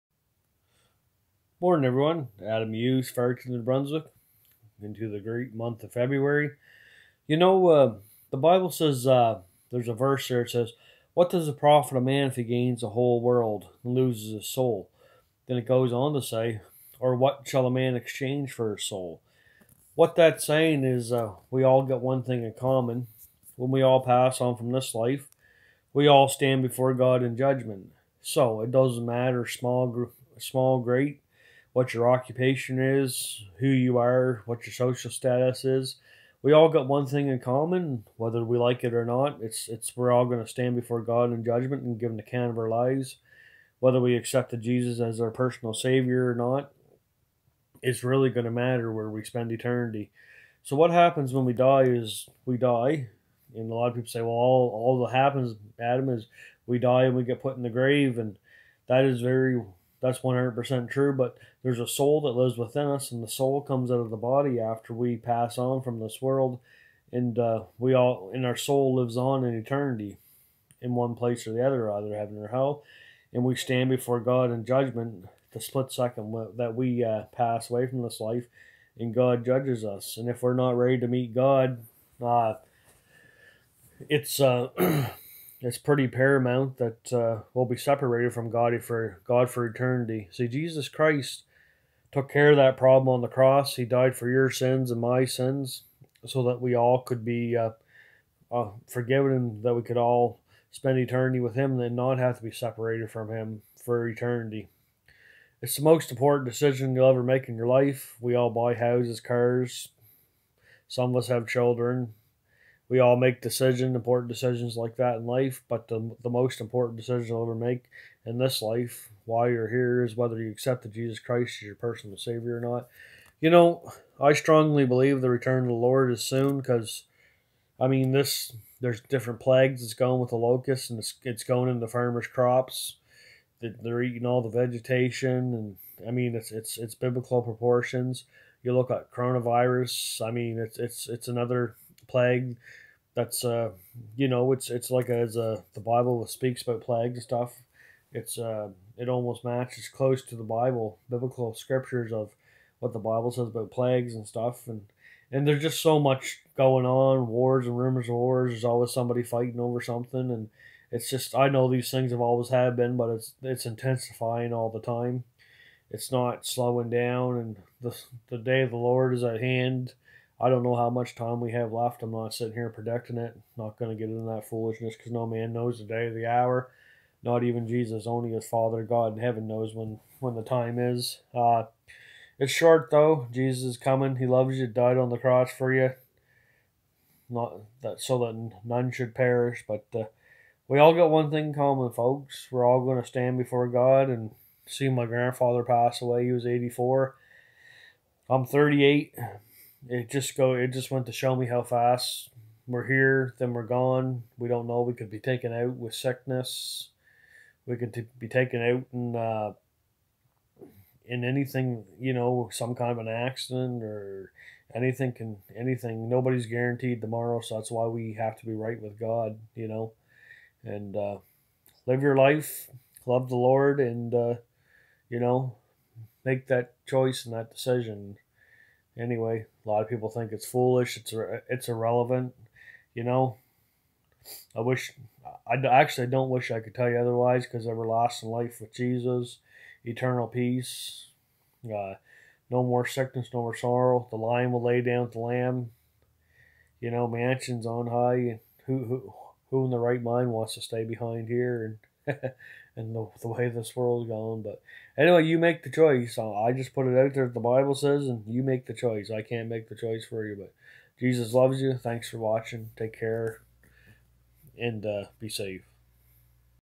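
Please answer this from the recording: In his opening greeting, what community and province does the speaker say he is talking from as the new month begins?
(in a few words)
Ferguson, New Brunswick.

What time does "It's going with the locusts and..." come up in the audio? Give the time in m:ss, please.
2:09.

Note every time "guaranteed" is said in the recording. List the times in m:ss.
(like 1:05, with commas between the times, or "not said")
3:36.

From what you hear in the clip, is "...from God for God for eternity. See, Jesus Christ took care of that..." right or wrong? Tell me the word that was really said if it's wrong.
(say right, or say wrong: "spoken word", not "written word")
right.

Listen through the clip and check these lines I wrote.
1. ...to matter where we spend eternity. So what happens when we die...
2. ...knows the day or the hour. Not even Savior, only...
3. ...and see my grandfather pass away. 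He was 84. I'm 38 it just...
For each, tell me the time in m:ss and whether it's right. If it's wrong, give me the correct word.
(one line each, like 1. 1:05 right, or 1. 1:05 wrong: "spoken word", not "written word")
1. 0:48 right
2. 2:55 wrong: "Jesus", not "Savior"
3. 3:14 right.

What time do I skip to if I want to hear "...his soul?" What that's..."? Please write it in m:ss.
0:18.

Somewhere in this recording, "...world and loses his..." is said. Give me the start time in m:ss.
0:13.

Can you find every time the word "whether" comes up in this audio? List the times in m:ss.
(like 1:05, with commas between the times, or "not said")
0:38, 0:43, 2:00.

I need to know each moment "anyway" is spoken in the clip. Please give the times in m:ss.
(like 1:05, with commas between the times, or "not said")
3:48, 4:14.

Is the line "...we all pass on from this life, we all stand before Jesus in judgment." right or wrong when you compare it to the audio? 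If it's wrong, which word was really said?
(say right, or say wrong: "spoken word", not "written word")
wrong: "God", not "Jesus".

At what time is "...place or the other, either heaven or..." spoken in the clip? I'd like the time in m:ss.
1:11.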